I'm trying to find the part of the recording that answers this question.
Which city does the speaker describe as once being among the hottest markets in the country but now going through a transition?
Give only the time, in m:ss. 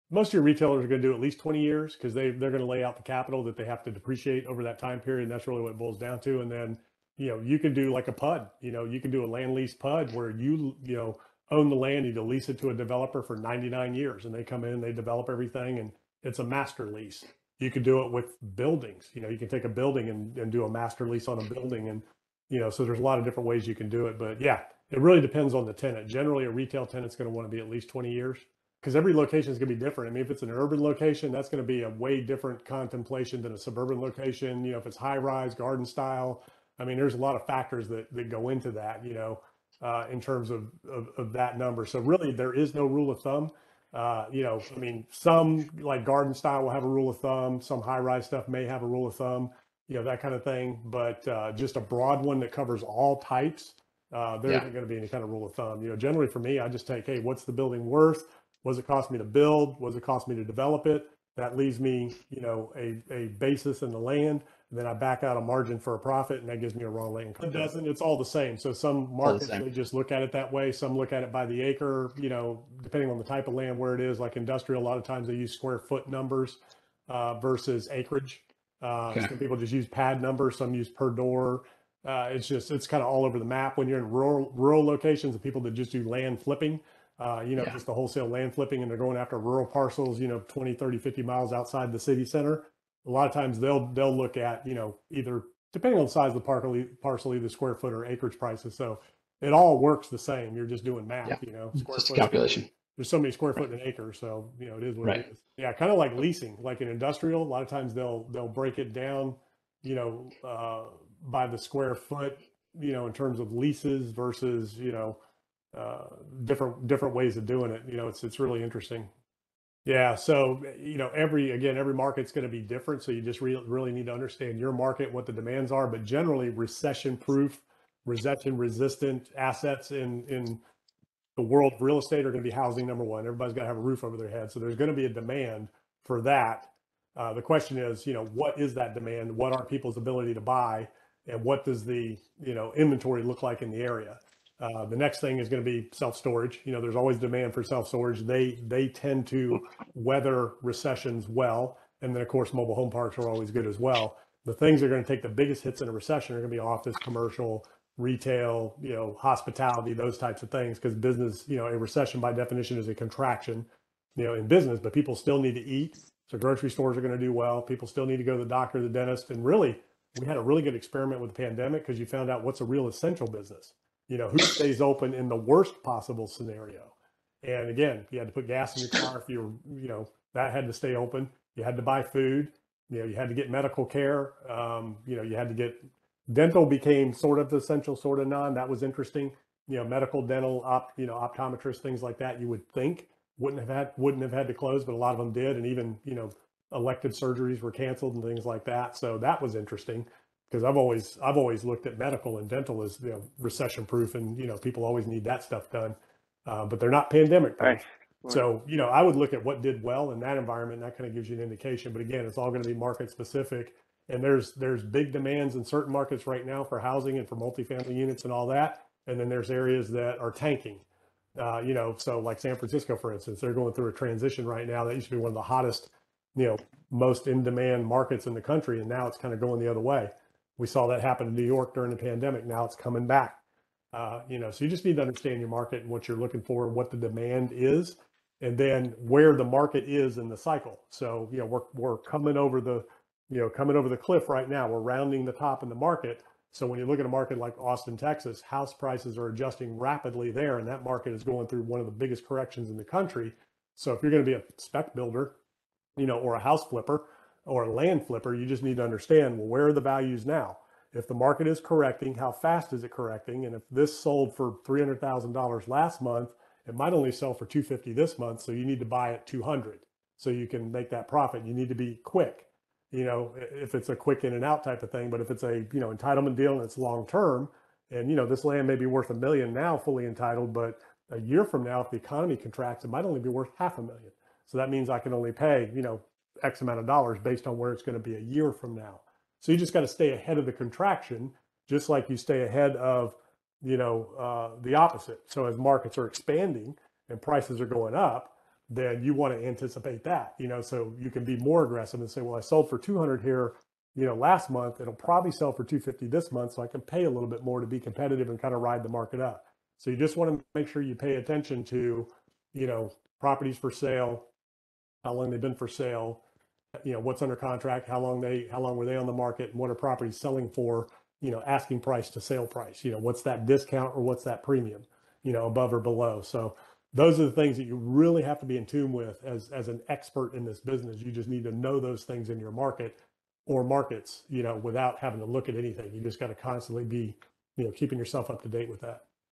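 3:42.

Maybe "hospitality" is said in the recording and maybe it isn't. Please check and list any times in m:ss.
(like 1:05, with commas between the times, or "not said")
2:39.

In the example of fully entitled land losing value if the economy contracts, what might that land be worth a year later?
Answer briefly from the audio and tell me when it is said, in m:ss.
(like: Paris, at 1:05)
half a million, at 4:43.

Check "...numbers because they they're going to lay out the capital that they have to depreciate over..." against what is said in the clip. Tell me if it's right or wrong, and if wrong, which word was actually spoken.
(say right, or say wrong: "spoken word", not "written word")
wrong: "years", not "numbers".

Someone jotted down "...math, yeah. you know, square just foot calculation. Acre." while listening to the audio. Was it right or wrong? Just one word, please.
right.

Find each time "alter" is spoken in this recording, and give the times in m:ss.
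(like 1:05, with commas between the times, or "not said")
not said.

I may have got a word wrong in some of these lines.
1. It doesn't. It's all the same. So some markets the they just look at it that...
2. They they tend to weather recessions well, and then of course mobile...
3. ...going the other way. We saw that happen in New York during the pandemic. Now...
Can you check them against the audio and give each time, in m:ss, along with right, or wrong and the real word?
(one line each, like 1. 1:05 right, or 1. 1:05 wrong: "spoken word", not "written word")
1. 1:07 right
2. 2:28 right
3. 3:49 right.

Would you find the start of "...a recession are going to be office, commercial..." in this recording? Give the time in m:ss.
2:35.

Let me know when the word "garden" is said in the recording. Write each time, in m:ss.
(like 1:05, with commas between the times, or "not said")
0:35, 0:46.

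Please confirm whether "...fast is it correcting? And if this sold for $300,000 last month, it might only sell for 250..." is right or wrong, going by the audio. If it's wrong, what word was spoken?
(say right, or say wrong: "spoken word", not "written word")
right.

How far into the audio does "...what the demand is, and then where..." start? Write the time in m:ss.
3:56.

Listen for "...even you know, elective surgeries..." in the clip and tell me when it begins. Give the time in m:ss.
3:15.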